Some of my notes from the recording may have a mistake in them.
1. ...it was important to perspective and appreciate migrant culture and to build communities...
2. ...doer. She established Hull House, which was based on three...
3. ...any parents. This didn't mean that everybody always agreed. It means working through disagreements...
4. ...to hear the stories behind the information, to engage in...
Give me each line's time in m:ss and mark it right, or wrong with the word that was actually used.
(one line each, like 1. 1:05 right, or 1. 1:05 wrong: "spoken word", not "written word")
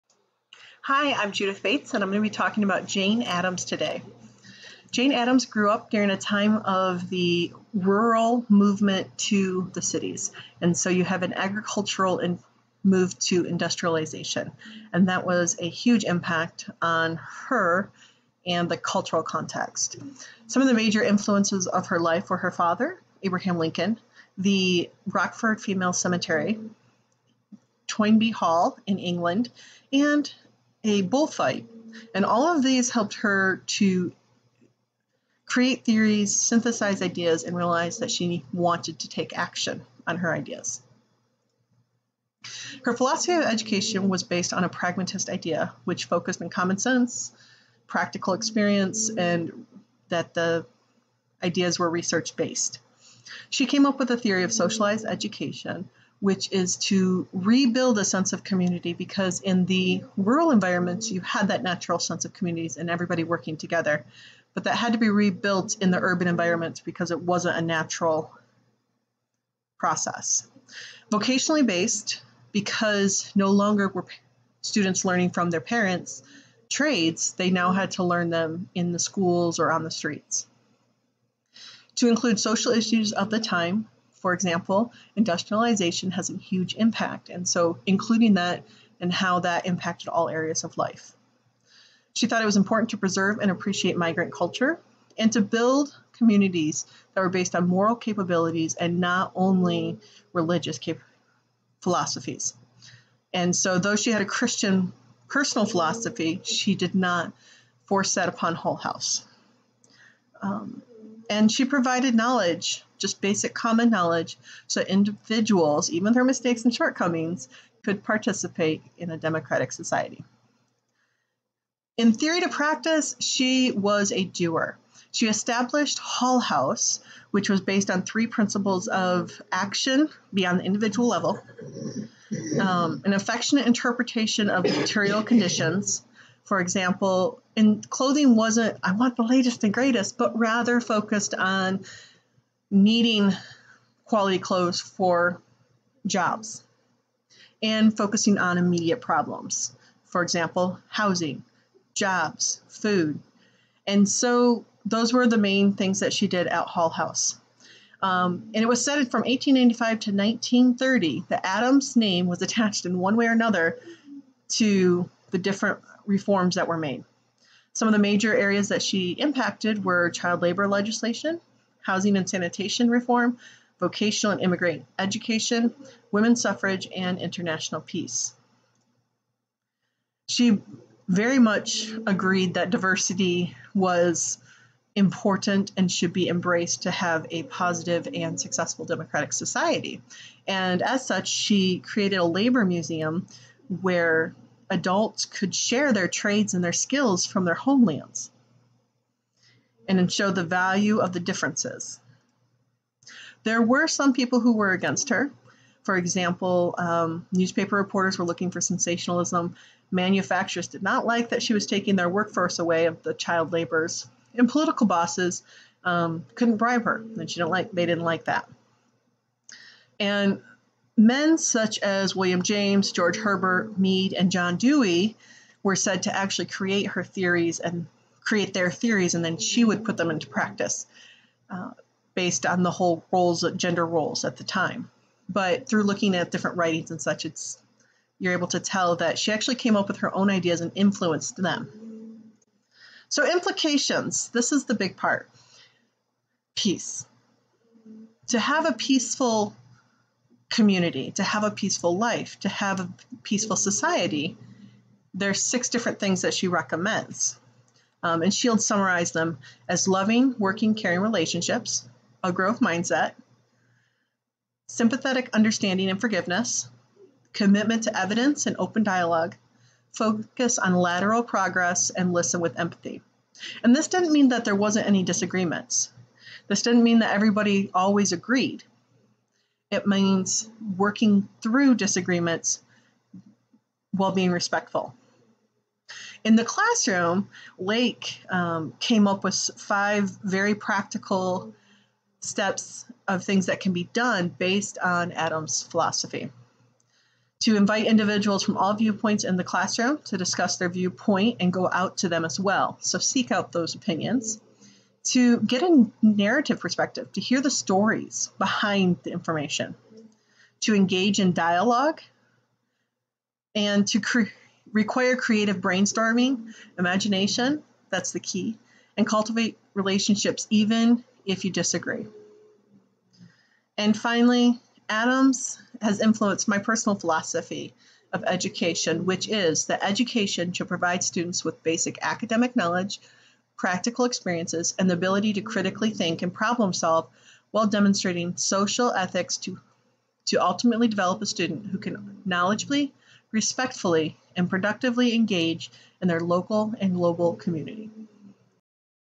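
1. 1:32 wrong: "preserve", not "perspective"
2. 2:04 right
3. 4:34 wrong: "disagreements", not "parents"
4. 5:07 right.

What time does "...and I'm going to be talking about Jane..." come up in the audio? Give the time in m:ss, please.
0:01.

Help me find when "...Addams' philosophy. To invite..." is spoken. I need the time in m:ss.
4:55.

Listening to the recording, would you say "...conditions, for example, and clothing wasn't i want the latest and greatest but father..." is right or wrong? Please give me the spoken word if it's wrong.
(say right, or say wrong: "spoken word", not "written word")
wrong: "rather", not "father".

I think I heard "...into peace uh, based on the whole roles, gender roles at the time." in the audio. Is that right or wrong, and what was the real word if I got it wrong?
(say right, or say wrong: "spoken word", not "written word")
wrong: "practice", not "peace".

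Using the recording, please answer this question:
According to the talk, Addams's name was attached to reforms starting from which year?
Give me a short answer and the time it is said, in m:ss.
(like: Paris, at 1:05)
1895, at 2:39.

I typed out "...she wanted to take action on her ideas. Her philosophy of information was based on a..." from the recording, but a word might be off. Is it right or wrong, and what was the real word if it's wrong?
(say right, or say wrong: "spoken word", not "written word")
wrong: "education", not "information".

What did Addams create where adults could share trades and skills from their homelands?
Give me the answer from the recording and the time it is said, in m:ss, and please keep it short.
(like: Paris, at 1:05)
A labor museum, at 3:12.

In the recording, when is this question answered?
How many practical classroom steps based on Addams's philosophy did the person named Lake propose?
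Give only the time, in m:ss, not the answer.
4:49.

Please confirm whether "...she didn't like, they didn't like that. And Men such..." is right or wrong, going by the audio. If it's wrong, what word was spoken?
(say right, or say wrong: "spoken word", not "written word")
right.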